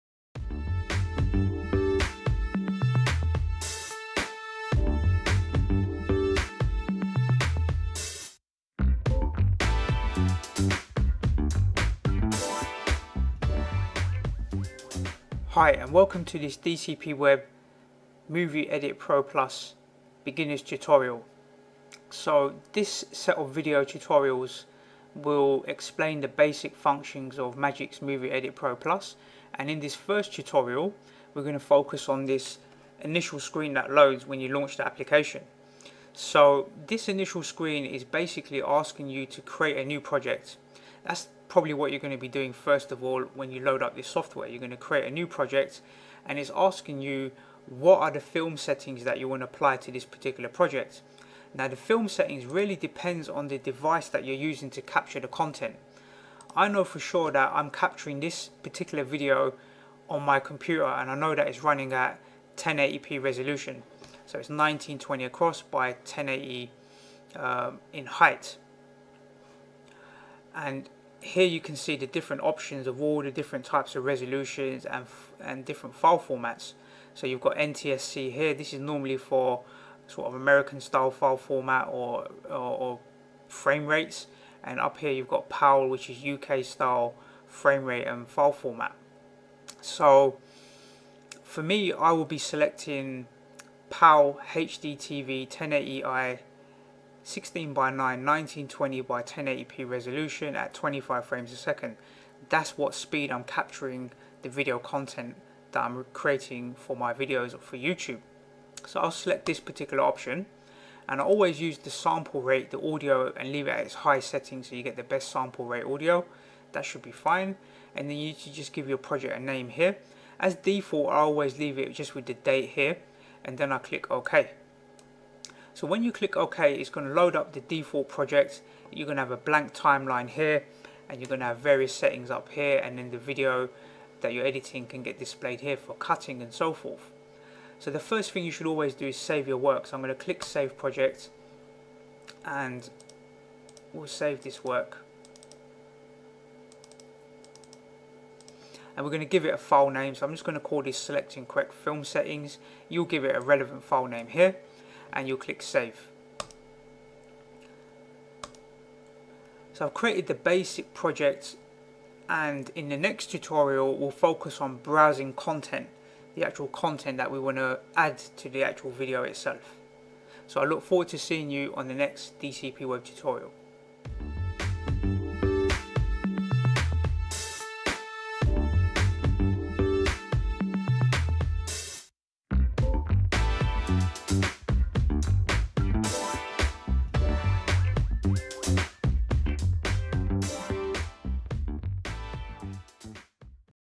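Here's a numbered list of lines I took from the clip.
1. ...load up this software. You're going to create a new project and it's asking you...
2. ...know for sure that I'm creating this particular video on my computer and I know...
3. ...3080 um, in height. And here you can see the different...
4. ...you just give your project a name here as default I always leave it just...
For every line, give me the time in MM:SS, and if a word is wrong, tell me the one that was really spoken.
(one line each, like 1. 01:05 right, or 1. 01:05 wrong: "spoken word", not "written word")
1. 00:43 right
2. 00:56 wrong: "capturing", not "creating"
3. 01:05 wrong: "1080", not "3080"
4. 01:58 right.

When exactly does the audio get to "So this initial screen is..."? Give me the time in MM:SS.
00:36.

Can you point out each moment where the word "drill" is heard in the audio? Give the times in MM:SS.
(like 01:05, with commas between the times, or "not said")
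not said.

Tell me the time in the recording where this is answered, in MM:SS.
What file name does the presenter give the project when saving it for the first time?
02:30.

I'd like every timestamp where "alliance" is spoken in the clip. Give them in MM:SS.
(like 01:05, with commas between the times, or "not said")
not said.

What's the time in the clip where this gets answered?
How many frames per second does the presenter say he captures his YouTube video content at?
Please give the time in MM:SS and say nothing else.
01:40.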